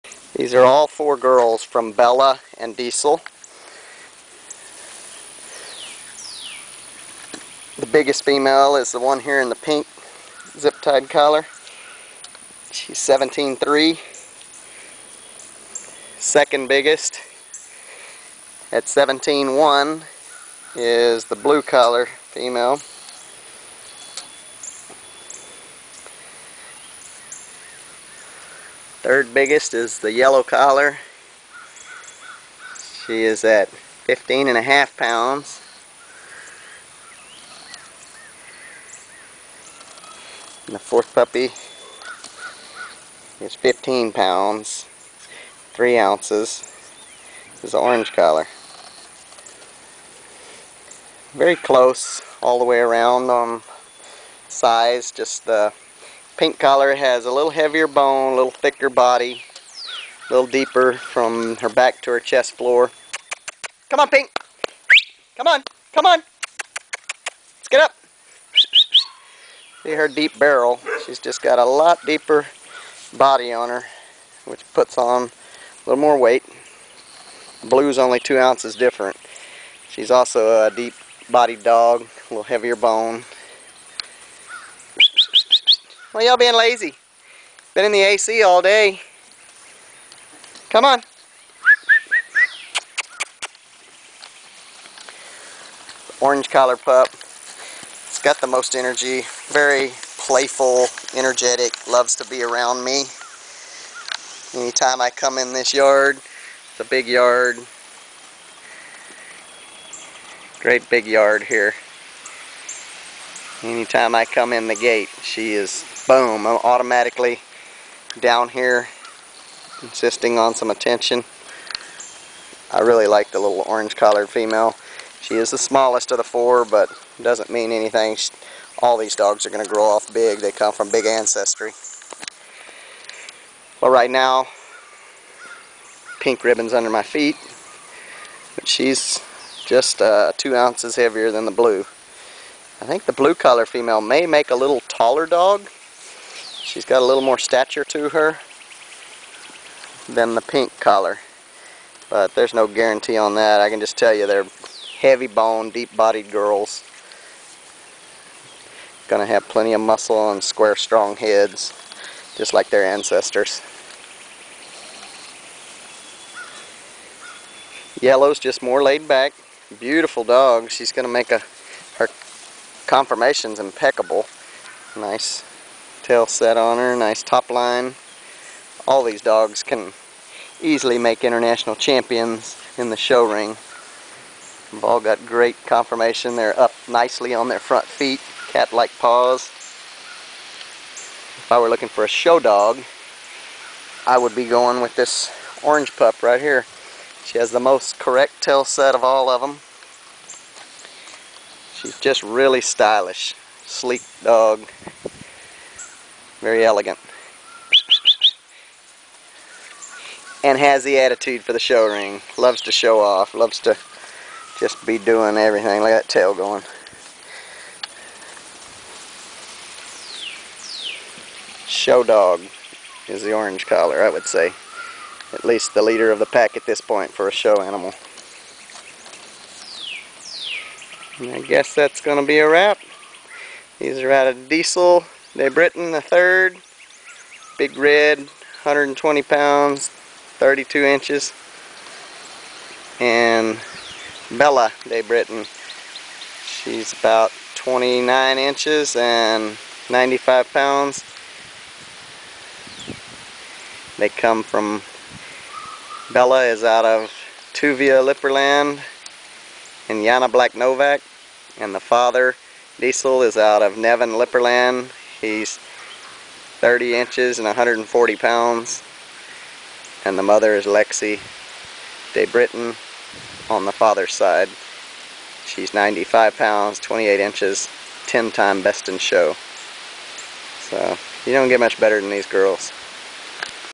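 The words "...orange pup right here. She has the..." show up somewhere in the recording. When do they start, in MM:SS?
03:15.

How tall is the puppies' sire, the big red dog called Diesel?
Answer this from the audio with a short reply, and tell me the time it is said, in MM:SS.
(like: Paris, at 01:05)
32 inches, at 03:59.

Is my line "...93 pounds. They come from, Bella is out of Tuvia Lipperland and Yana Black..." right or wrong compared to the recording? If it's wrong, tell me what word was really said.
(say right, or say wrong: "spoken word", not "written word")
wrong: "95", not "93".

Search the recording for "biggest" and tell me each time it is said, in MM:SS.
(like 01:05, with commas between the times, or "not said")
00:07, 00:16, 00:29.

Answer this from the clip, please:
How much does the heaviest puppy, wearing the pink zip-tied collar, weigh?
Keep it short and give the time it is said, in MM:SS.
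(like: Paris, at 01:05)
17.3, at 00:12.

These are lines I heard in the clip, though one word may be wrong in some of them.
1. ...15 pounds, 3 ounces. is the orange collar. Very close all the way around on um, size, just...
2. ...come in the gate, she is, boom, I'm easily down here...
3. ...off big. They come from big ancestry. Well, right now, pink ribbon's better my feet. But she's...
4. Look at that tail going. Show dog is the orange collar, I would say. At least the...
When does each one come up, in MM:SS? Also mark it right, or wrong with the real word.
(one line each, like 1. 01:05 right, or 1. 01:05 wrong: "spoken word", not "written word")
1. 00:43 right
2. 01:54 wrong: "automatically", not "easily"
3. 02:09 wrong: "under", not "better"
4. 03:35 right.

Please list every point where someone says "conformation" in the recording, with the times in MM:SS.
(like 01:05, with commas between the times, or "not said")
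02:52, 03:05.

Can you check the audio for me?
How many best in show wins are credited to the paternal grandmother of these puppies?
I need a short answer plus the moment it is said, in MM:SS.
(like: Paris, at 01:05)
10, at 04:38.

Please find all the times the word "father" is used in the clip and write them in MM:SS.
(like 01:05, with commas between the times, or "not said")
04:21, 04:33.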